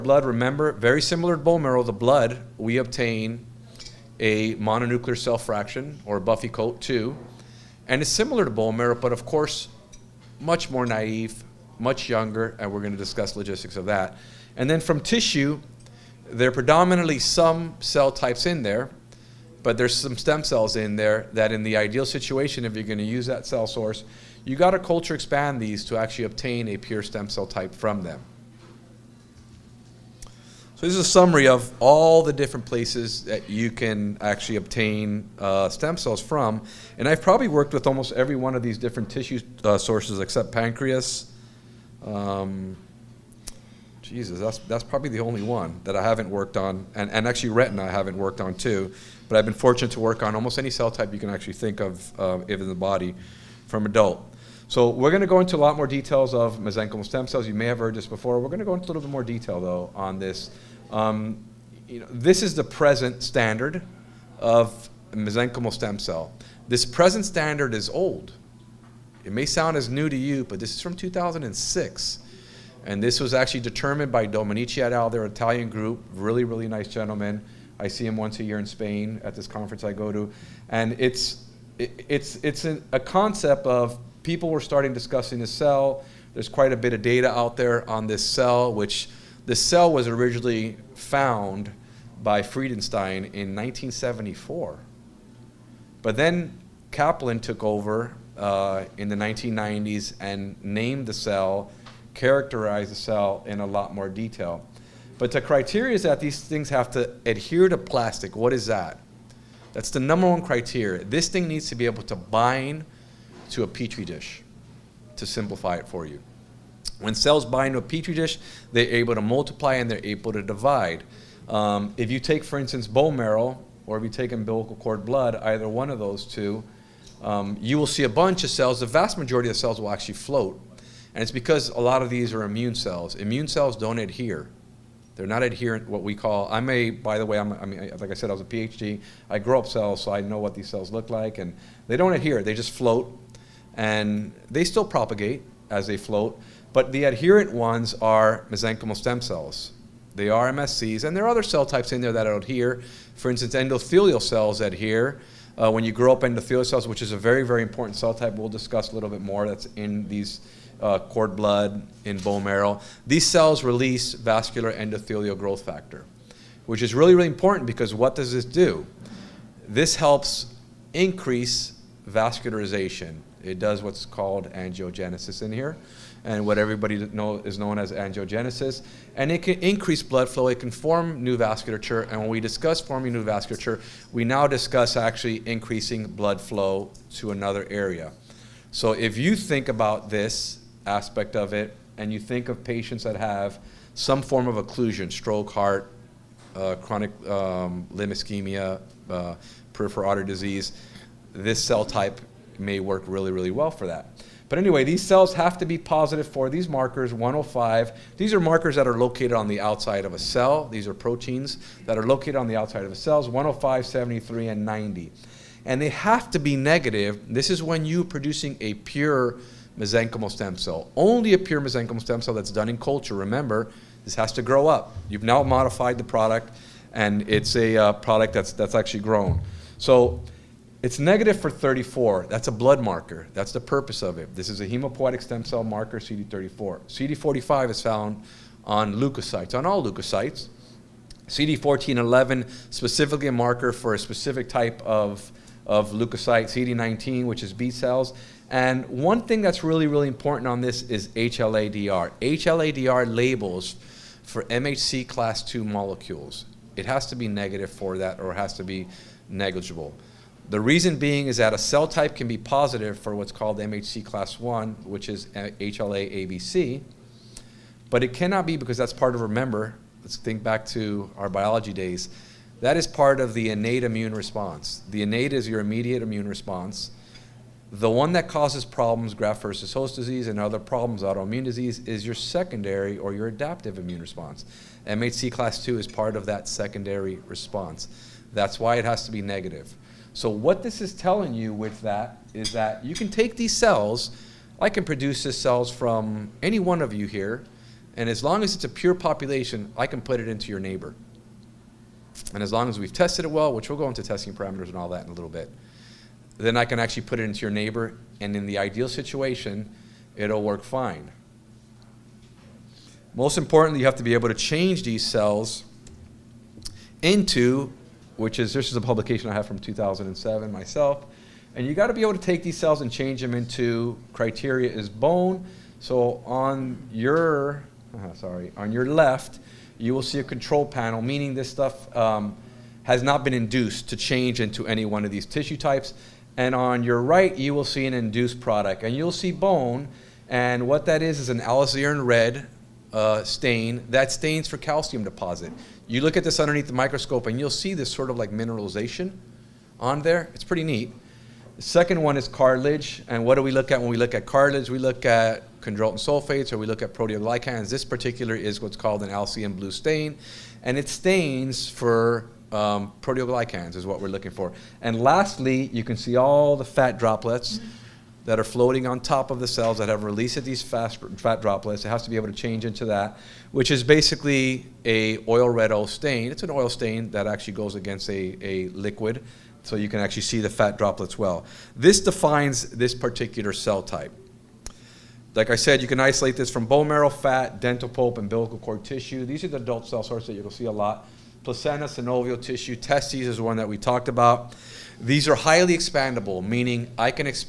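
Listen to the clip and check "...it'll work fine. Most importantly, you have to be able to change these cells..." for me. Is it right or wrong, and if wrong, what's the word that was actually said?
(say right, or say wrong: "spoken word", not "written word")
right.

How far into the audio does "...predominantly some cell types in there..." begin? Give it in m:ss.
0:16.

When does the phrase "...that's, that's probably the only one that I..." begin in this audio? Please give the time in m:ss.
0:44.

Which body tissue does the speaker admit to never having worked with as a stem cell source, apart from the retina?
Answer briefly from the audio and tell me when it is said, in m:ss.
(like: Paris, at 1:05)
Pancreas, at 0:40.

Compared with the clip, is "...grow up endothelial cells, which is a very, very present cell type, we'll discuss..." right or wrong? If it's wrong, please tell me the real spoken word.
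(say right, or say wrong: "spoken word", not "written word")
wrong: "important", not "present".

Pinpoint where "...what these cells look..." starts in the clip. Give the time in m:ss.
2:20.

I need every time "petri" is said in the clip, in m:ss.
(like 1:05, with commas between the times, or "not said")
1:53, 1:57.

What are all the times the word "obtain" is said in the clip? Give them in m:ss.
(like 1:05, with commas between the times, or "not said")
0:02, 0:26, 0:34.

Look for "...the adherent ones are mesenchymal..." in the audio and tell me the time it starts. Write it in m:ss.
2:26.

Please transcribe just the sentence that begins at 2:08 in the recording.
The vast majority of the cells will actually float.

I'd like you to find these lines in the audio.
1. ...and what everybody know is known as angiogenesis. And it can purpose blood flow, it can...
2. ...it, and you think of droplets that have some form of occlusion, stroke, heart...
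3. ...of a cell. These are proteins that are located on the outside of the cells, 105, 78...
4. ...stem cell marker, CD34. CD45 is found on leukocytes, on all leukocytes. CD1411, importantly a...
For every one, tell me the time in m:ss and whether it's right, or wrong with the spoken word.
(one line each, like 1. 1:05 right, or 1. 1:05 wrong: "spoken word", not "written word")
1. 2:56 wrong: "increase", not "purpose"
2. 3:11 wrong: "patients", not "droplets"
3. 3:30 wrong: "73", not "78"
4. 3:55 wrong: "specifically", not "importantly".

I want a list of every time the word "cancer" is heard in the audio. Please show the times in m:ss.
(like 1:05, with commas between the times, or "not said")
not said.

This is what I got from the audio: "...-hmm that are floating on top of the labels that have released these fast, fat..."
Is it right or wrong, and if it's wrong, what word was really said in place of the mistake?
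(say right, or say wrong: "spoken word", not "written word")
wrong: "cells", not "labels".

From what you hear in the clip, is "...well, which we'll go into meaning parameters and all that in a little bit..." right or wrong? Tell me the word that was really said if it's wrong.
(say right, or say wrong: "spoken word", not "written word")
wrong: "testing", not "meaning".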